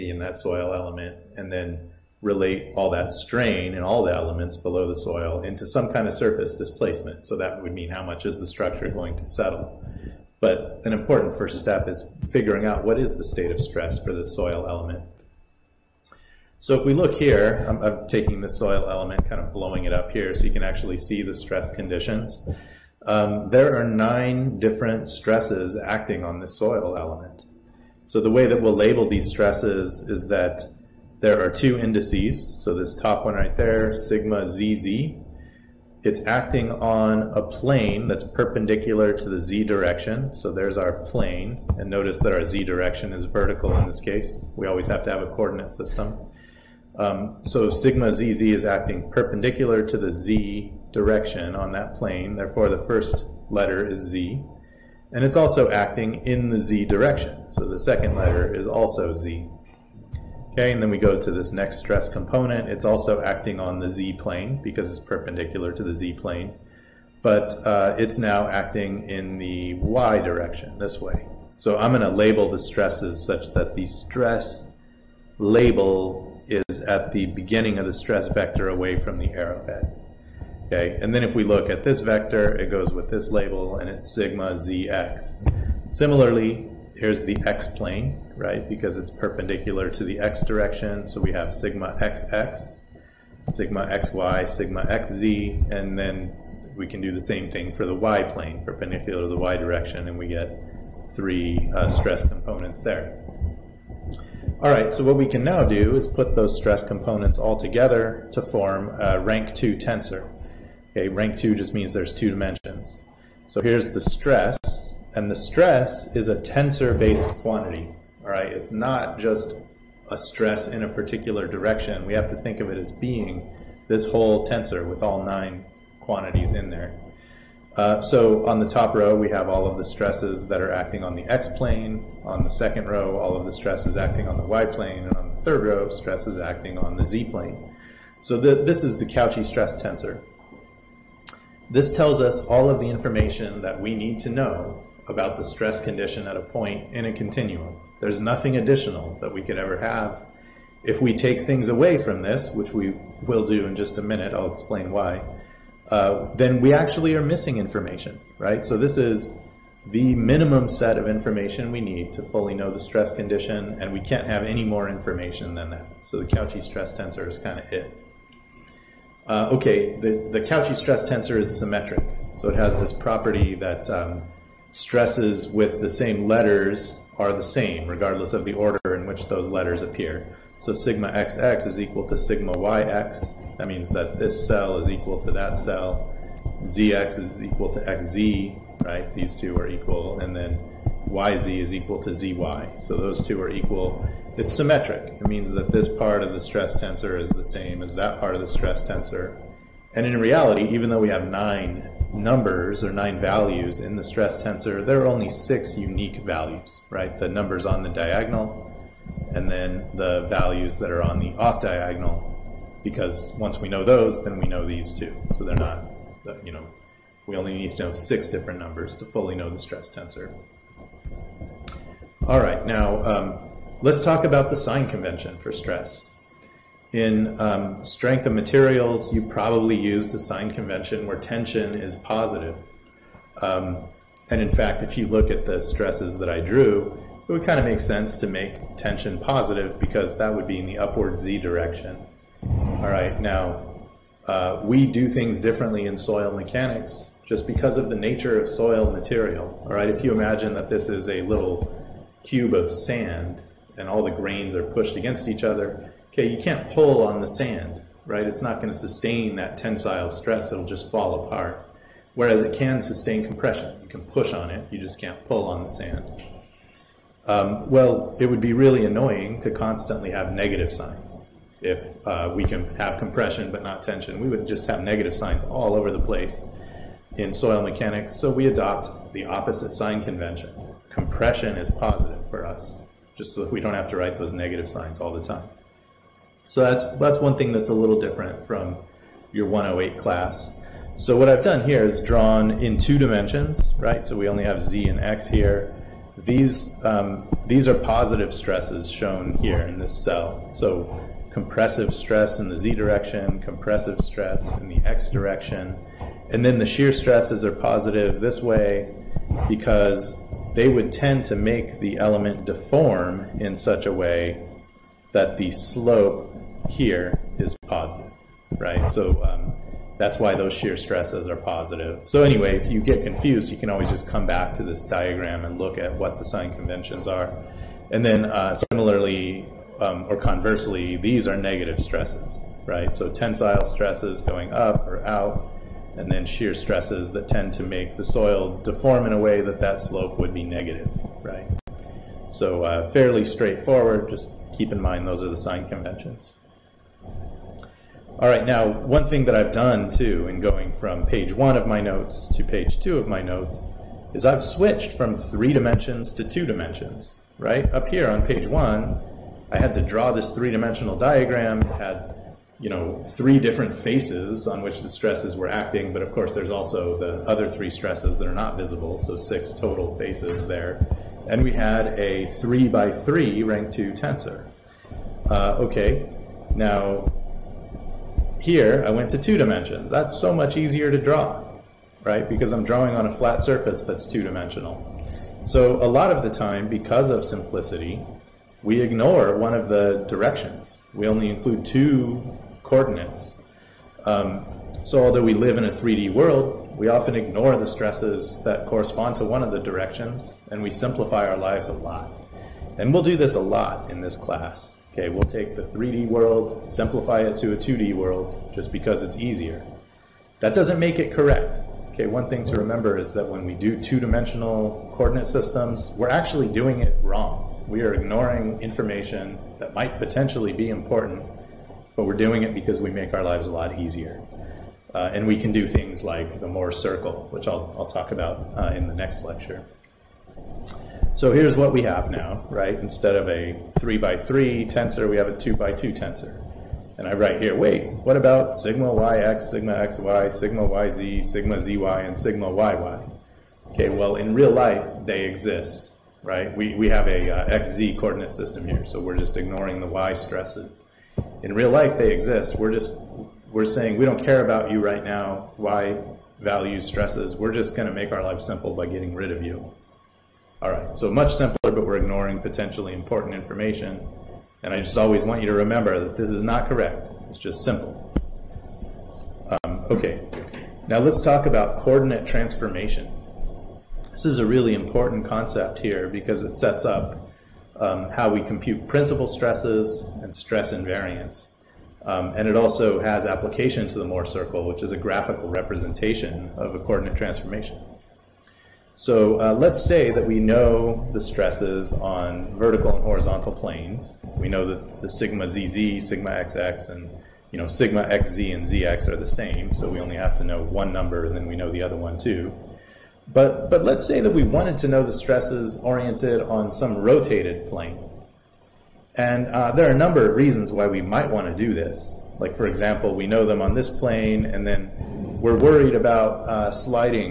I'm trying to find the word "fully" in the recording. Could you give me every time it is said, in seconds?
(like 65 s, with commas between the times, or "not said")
162 s, 219 s.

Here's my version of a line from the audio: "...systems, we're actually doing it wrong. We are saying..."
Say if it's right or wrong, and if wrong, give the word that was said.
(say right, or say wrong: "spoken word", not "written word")
wrong: "ignoring", not "saying".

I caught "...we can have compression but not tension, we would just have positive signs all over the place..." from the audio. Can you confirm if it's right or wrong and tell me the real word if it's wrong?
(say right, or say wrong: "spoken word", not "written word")
wrong: "negative", not "positive".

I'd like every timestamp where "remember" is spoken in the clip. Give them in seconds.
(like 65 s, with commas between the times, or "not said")
412 s, 465 s.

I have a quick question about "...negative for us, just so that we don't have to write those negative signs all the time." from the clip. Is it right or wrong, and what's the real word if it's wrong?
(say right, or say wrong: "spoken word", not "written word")
wrong: "positive", not "negative".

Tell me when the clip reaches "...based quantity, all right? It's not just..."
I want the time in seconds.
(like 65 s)
116 s.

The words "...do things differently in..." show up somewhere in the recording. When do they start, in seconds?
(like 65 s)
244 s.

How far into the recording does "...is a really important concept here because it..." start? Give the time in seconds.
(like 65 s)
474 s.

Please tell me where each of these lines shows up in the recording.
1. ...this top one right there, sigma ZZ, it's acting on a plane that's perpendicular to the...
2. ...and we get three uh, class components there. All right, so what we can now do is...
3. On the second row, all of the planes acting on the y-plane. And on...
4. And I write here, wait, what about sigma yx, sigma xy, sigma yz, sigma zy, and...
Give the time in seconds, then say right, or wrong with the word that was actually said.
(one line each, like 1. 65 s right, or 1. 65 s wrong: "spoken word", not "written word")
1. 32 s right
2. 100 s wrong: "stress", not "class"
3. 132 s wrong: "stresses", not "planes"
4. 436 s right.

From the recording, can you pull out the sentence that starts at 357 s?
Up here on page one, I had to draw this three dimensional diagram.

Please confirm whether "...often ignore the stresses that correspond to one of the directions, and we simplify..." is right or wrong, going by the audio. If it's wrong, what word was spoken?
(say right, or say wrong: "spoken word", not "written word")
right.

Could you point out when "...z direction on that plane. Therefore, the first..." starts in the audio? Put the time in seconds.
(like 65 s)
50 s.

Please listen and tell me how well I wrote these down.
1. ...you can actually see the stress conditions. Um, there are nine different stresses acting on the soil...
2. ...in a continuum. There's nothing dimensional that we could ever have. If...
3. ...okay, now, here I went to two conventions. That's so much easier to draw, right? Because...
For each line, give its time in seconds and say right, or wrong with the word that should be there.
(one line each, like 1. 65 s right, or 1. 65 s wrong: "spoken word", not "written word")
1. 20 s right
2. 146 s wrong: "additional", not "dimensional"
3. 375 s wrong: "dimensions", not "conventions".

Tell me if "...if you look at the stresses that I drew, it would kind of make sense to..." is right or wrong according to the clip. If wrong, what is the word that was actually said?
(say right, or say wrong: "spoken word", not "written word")
right.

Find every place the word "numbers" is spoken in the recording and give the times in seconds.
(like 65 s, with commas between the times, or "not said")
202 s, 207 s, 218 s, 500 s, 509 s.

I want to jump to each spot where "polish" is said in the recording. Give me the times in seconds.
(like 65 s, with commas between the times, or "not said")
not said.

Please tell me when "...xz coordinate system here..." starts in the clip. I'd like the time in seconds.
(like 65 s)
447 s.